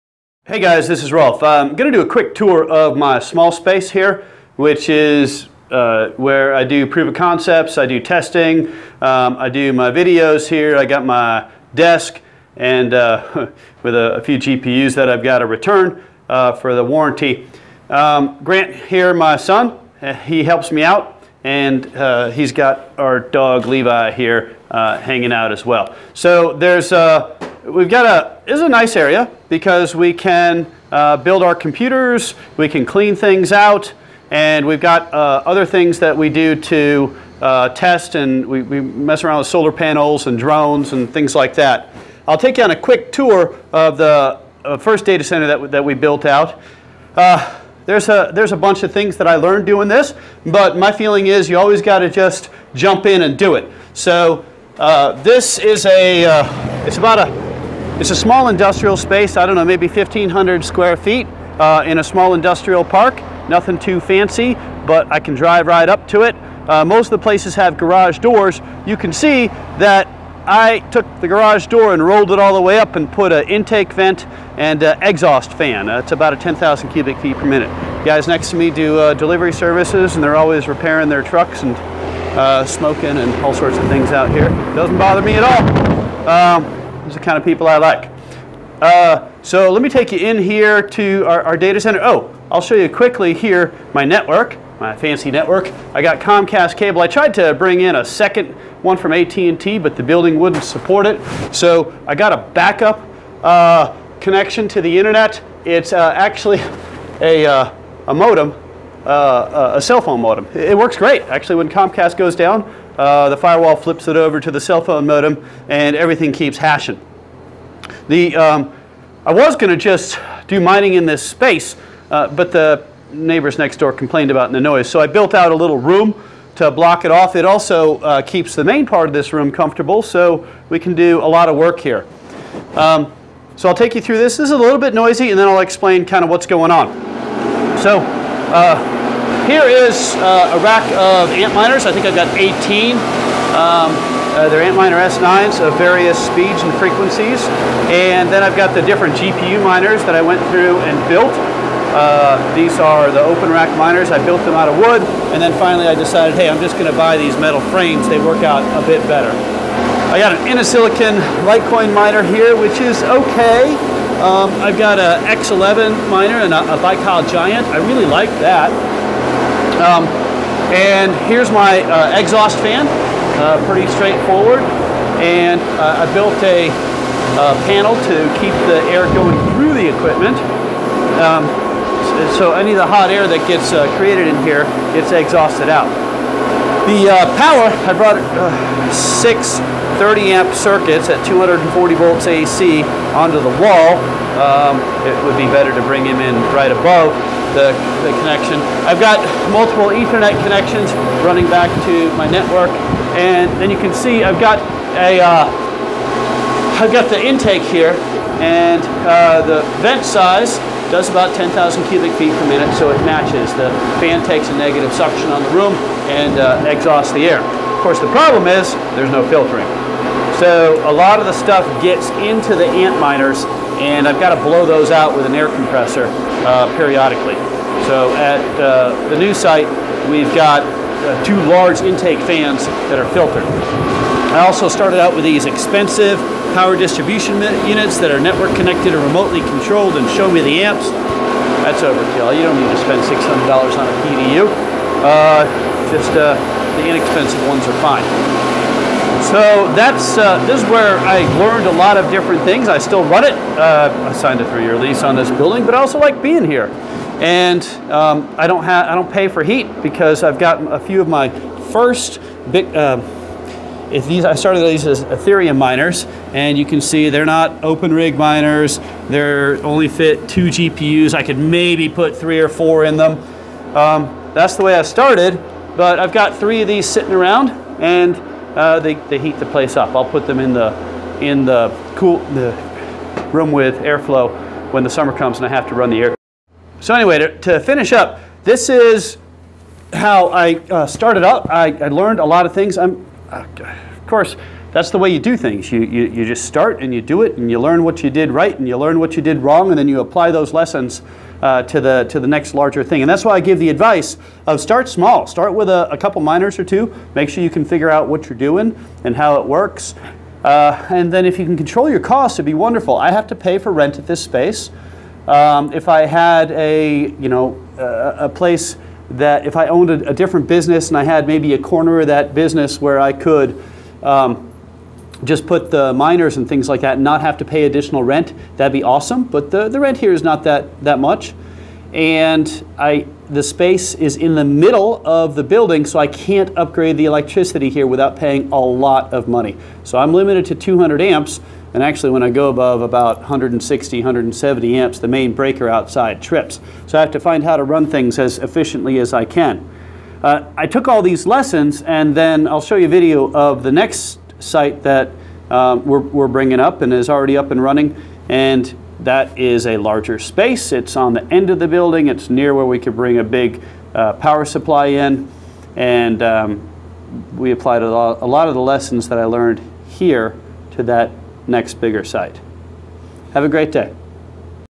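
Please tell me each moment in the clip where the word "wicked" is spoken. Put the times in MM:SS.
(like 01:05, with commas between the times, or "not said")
not said.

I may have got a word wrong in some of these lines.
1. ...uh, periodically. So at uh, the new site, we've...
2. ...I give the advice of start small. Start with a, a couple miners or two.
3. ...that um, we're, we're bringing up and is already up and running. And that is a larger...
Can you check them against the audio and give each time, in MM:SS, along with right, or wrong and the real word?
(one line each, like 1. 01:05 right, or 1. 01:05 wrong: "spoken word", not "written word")
1. 03:46 right
2. 05:03 right
3. 05:54 right.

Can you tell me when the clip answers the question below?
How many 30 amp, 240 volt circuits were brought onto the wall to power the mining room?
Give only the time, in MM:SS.
03:08.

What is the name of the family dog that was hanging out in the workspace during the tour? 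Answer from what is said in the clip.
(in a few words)
Levi.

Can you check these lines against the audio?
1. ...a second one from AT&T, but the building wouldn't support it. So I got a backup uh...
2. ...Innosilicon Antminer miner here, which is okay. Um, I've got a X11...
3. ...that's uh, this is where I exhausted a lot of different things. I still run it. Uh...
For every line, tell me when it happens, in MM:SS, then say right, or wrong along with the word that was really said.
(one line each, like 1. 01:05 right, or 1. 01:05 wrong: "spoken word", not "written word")
1. 01:37 right
2. 02:40 wrong: "Litecoin", not "Antminer"
3. 04:09 wrong: "learned", not "exhausted".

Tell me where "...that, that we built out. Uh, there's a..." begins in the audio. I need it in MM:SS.
00:45.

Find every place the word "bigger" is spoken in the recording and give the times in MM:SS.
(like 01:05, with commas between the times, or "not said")
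06:11.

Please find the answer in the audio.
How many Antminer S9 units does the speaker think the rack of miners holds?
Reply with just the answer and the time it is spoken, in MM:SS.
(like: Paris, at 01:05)
18, at 02:22.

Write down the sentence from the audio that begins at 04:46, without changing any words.
So anyway, to, to finish up, this is how I uh, started up.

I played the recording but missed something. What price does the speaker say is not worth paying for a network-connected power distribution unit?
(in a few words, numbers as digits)
$600.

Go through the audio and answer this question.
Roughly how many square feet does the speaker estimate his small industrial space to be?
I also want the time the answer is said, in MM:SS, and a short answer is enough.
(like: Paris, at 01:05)
1,500, at 00:59.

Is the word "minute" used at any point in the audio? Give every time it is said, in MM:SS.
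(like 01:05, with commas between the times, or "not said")
01:17, 03:32.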